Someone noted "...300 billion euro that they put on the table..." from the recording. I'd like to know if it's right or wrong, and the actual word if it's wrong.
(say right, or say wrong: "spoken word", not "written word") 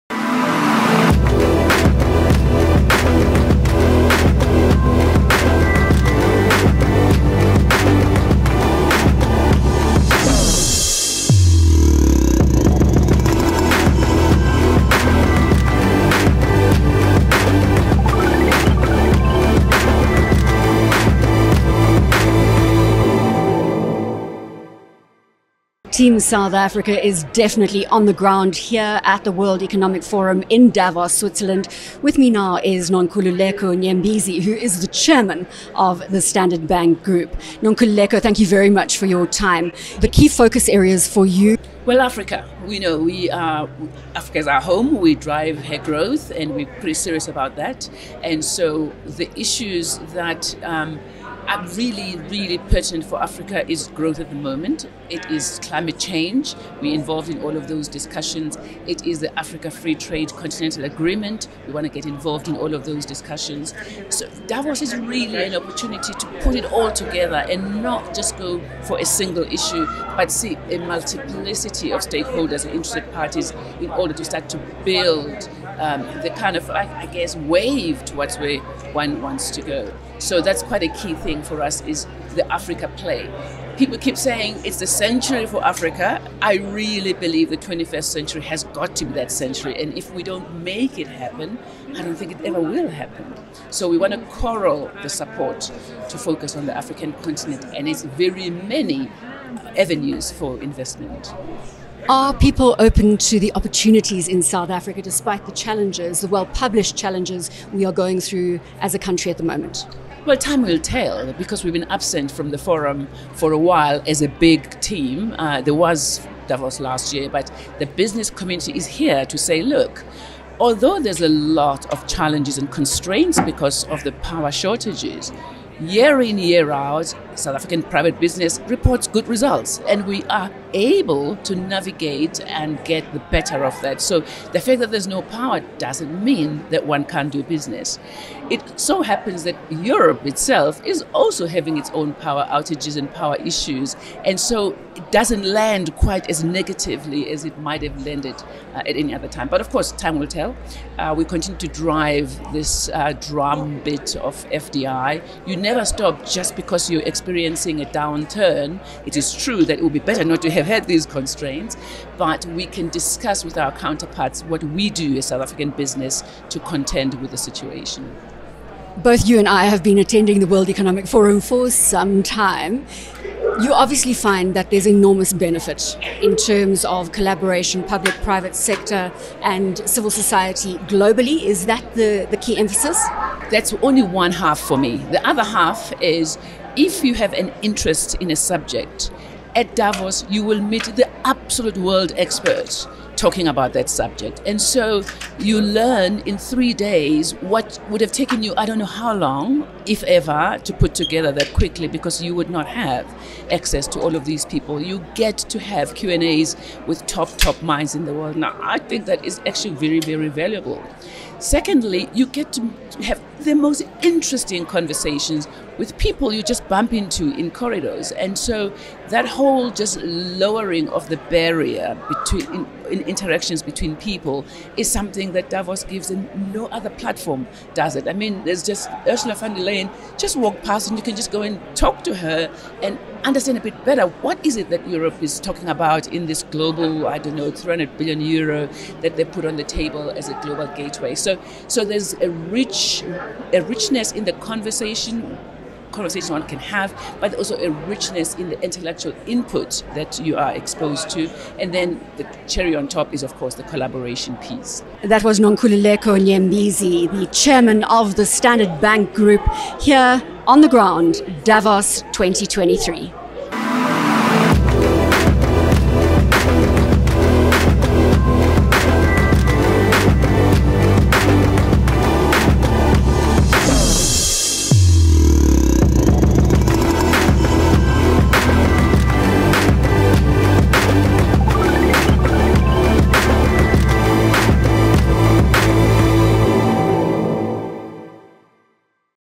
right.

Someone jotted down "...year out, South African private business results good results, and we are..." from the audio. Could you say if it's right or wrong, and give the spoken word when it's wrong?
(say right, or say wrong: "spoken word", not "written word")
wrong: "reports", not "results".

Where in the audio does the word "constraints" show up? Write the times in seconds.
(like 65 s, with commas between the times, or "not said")
122 s, 161 s.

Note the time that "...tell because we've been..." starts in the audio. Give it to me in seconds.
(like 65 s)
110 s.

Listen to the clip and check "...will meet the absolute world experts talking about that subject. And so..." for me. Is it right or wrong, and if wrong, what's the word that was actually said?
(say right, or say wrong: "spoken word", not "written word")
right.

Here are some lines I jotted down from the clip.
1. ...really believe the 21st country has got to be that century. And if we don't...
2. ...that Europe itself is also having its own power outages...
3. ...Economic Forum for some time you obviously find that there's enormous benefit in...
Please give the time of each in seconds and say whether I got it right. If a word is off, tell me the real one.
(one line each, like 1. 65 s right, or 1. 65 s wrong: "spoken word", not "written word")
1. 86 s wrong: "century", not "country"
2. 139 s right
3. 170 s right.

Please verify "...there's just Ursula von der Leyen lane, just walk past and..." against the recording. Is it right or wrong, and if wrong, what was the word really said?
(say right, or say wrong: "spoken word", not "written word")
right.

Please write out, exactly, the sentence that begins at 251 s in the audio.
And then the cherry on top is, of course, the collaboration piece.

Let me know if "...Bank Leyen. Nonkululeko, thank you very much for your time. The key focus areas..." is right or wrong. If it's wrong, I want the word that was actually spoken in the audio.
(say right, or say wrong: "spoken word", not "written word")
wrong: "Group", not "Leyen".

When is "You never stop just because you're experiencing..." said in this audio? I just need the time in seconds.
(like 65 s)
155 s.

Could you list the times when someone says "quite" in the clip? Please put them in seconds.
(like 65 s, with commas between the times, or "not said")
80 s, 145 s.